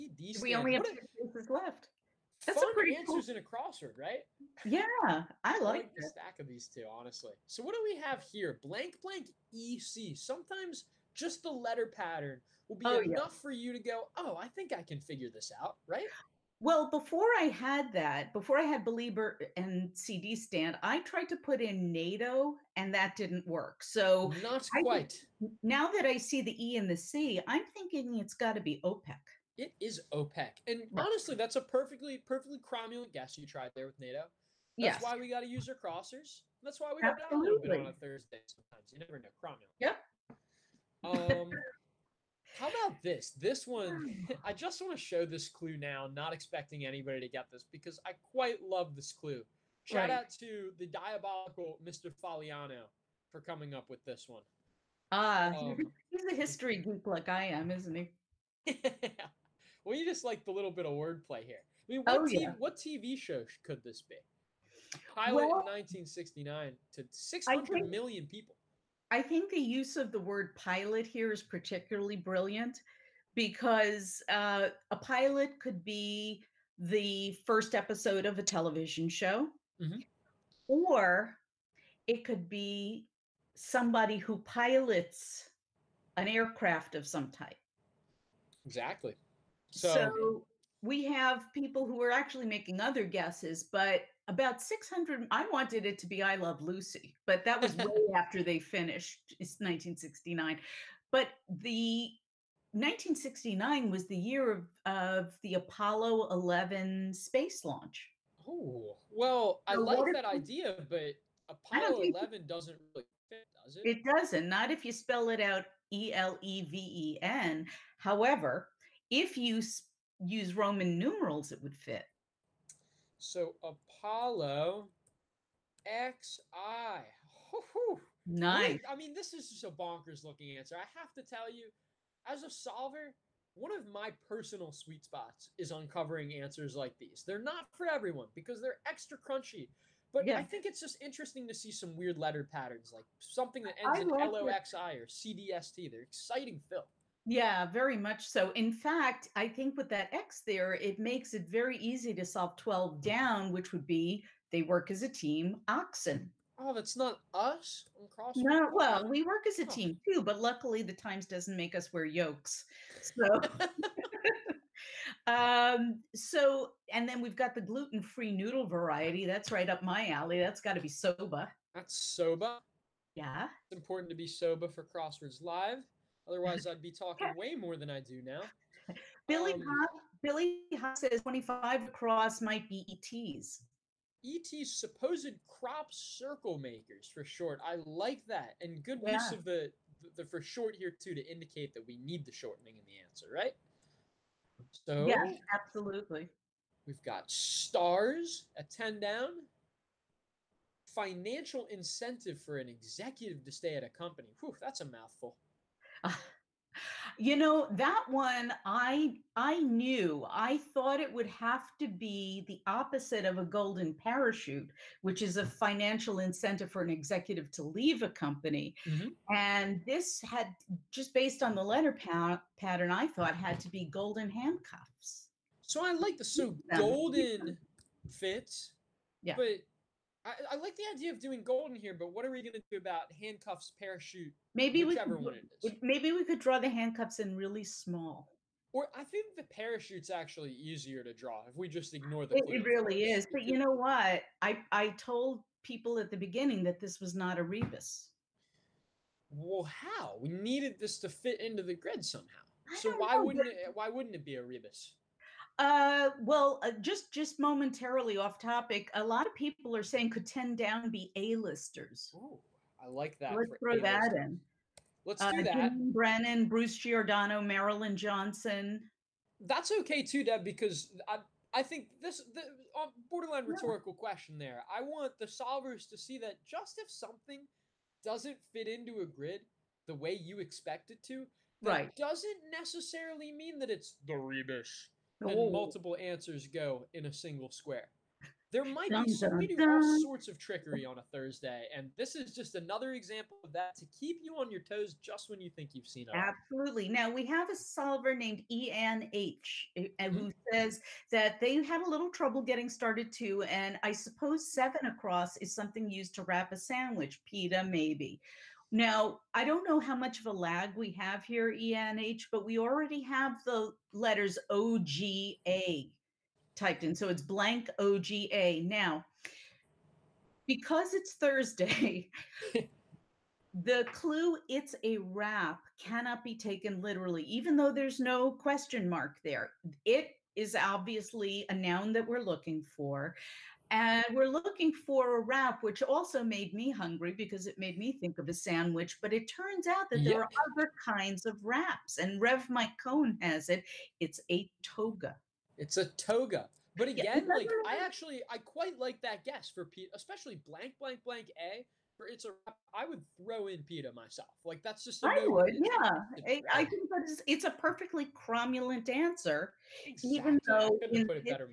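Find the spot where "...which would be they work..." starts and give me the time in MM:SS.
02:33.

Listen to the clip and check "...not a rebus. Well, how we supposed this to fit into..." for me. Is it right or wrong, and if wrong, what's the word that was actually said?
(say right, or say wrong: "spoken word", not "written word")
wrong: "needed", not "supposed".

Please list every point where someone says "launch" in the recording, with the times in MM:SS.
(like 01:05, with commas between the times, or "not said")
01:47.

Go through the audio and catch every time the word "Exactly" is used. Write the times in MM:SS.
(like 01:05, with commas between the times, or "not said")
01:28, 05:59.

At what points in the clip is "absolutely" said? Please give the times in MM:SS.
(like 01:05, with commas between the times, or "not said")
03:15, 04:56.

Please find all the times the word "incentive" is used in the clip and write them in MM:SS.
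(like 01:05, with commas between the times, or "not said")
03:21, 03:36.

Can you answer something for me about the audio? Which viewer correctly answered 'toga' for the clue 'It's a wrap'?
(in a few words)
Rev Mike Cohn.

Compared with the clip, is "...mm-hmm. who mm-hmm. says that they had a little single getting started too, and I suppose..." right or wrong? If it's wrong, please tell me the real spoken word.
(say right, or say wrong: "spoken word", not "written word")
wrong: "trouble", not "single".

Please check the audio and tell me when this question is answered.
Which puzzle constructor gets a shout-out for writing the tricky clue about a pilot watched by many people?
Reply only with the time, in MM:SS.
00:51.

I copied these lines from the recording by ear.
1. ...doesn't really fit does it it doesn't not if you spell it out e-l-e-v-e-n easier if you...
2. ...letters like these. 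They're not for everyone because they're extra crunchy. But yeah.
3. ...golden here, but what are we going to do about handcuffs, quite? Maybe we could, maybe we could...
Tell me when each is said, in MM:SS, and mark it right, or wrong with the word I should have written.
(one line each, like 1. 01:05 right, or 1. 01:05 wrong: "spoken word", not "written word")
1. 01:52 wrong: "however", not "easier"
2. 02:16 wrong: "answers", not "letters"
3. 03:51 wrong: "parachute", not "quite".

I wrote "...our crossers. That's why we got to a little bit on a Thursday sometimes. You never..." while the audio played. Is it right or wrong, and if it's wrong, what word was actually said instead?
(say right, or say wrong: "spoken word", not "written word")
right.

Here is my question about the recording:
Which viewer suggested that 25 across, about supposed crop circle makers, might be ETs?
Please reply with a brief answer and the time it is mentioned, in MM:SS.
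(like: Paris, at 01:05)
Billy Huff, at 03:00.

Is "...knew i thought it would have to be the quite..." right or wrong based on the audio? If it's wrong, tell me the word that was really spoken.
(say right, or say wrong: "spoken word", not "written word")
wrong: "opposite", not "quite".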